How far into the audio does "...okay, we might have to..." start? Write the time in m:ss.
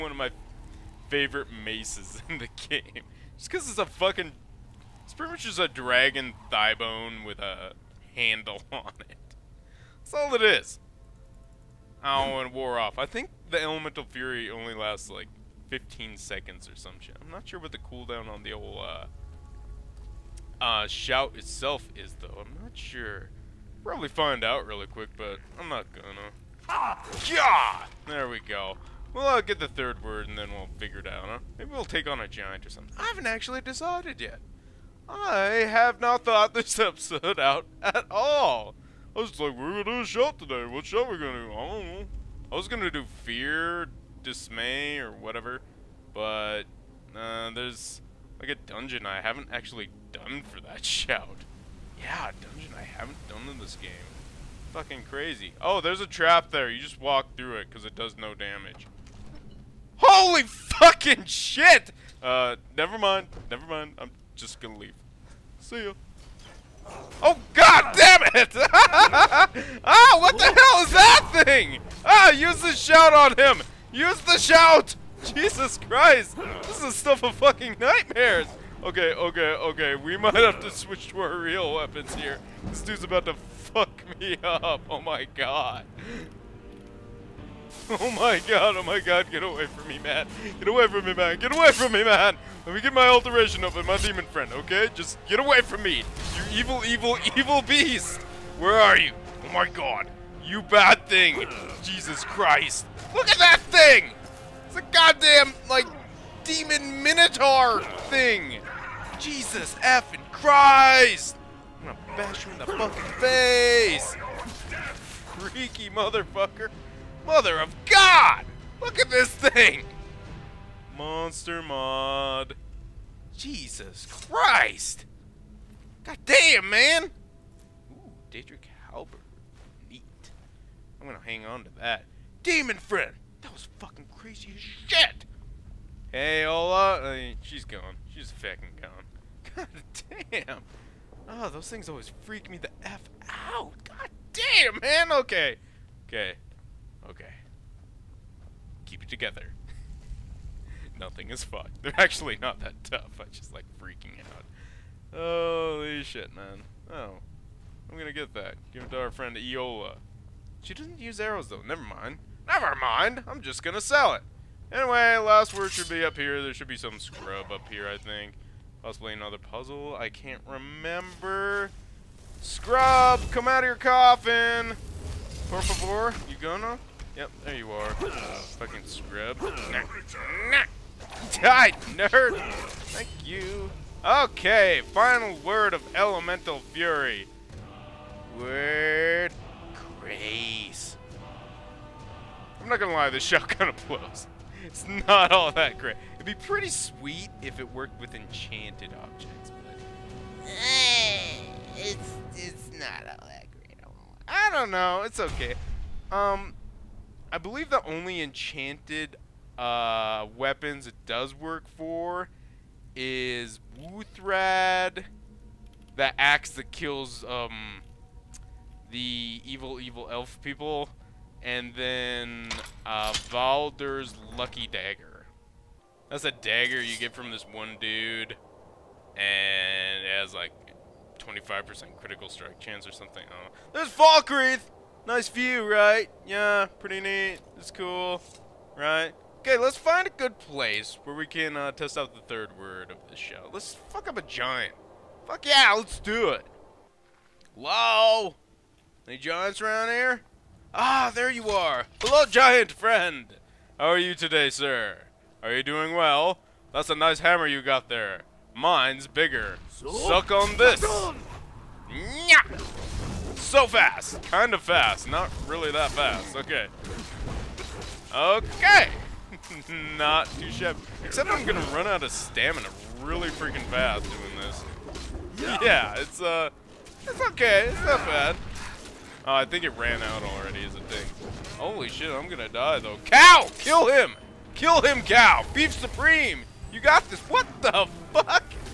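1:19.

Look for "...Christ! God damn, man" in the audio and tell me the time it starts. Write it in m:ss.
2:04.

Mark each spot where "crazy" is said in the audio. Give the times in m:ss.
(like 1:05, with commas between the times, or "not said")
0:55, 2:14.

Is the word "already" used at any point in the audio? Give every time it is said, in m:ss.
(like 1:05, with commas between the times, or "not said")
4:40.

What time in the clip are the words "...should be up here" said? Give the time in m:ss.
2:45.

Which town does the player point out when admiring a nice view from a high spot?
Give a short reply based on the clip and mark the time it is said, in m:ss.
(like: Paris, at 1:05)
Falkreath, at 3:53.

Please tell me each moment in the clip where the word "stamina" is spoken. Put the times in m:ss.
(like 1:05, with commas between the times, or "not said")
4:32.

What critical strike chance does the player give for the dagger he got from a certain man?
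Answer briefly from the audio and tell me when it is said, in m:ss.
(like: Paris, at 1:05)
25%, at 3:51.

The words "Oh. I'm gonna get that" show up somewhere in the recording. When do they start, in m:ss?
2:36.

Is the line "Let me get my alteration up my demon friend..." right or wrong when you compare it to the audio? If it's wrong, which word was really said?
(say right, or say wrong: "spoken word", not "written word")
right.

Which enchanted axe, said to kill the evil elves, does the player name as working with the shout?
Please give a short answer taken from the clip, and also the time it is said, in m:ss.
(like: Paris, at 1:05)
Wuuthrad, at 3:33.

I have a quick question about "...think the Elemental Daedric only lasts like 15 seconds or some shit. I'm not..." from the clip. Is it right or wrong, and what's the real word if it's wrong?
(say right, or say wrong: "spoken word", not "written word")
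wrong: "Fury", not "Daedric".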